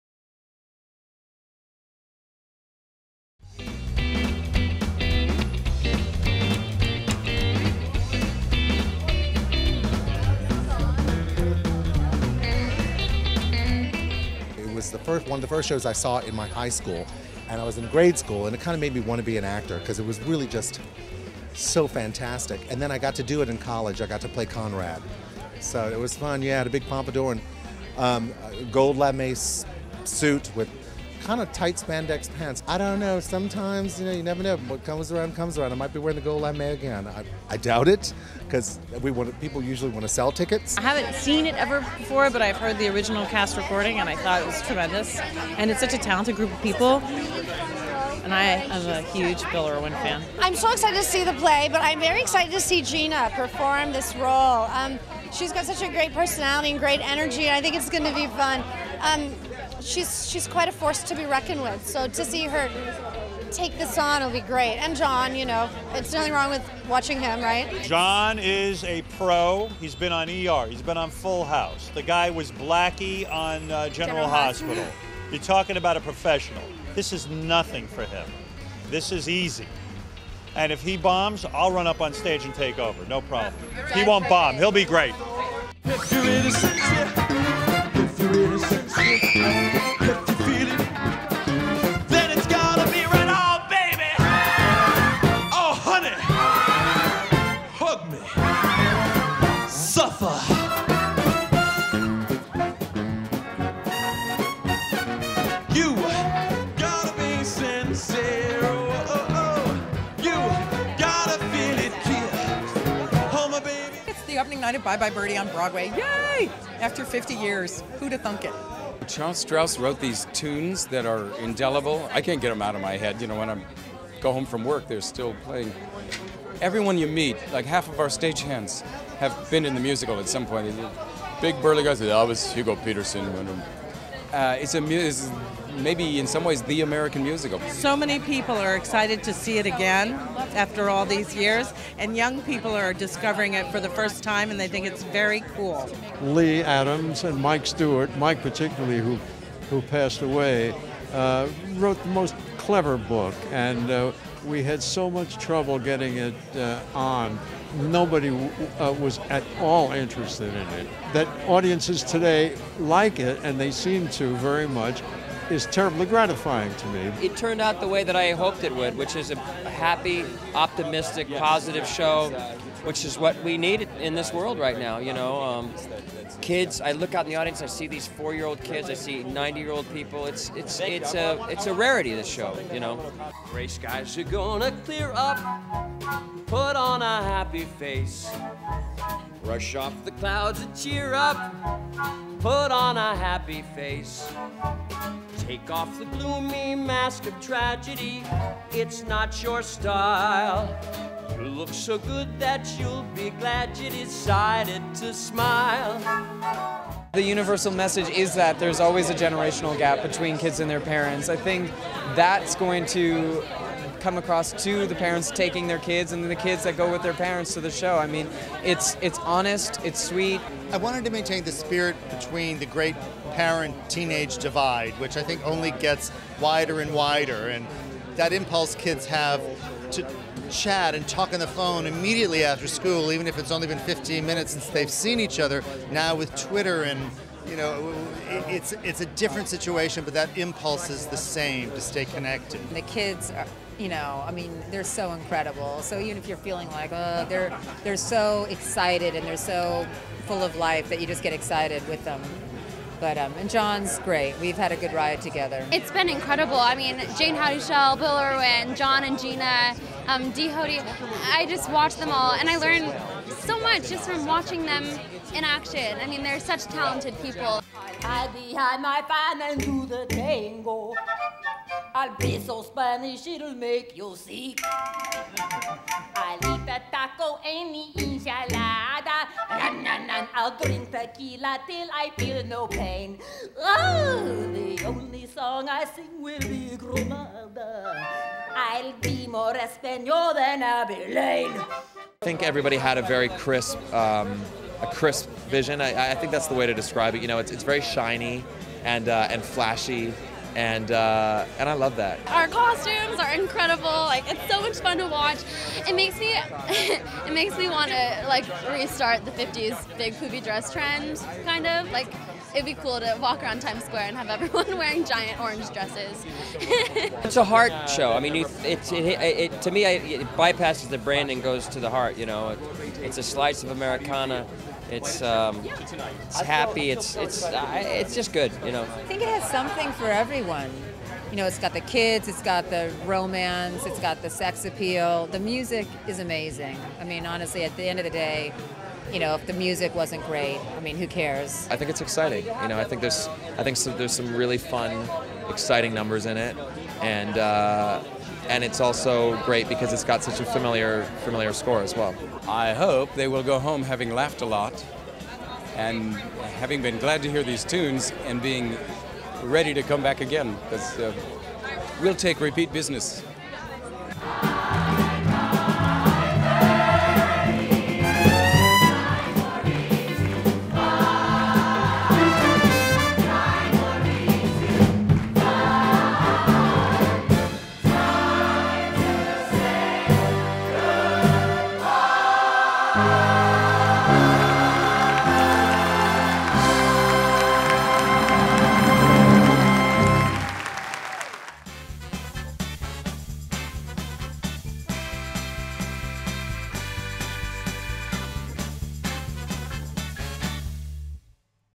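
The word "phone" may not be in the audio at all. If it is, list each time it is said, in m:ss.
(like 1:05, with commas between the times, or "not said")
3:51.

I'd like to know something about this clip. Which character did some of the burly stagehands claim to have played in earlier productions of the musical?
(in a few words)
Hugo Peterson.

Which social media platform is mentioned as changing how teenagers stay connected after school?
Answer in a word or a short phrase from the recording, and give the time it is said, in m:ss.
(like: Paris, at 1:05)
Twitter, at 3:56.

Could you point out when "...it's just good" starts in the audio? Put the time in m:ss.
5:27.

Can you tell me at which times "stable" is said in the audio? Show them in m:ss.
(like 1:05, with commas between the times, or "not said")
not said.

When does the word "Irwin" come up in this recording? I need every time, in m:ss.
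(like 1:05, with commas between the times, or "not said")
0:49, 4:18.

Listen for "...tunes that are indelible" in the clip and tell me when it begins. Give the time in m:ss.
2:00.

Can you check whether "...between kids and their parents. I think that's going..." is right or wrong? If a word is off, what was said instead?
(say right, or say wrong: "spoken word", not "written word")
right.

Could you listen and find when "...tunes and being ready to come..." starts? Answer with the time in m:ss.
5:57.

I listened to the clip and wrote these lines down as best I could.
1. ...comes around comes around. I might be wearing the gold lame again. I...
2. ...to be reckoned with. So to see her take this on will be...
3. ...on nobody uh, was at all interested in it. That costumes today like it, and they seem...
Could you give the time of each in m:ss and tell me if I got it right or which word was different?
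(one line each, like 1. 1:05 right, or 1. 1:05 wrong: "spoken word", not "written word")
1. 0:34 right
2. 1:01 right
3. 2:36 wrong: "audiences", not "costumes".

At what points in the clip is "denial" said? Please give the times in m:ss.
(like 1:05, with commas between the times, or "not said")
not said.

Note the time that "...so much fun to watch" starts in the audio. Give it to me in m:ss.
5:04.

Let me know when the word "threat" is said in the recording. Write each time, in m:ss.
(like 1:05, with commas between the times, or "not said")
not said.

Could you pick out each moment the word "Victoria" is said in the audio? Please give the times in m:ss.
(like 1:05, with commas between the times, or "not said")
not said.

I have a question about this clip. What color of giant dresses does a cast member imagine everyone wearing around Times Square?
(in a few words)
orange.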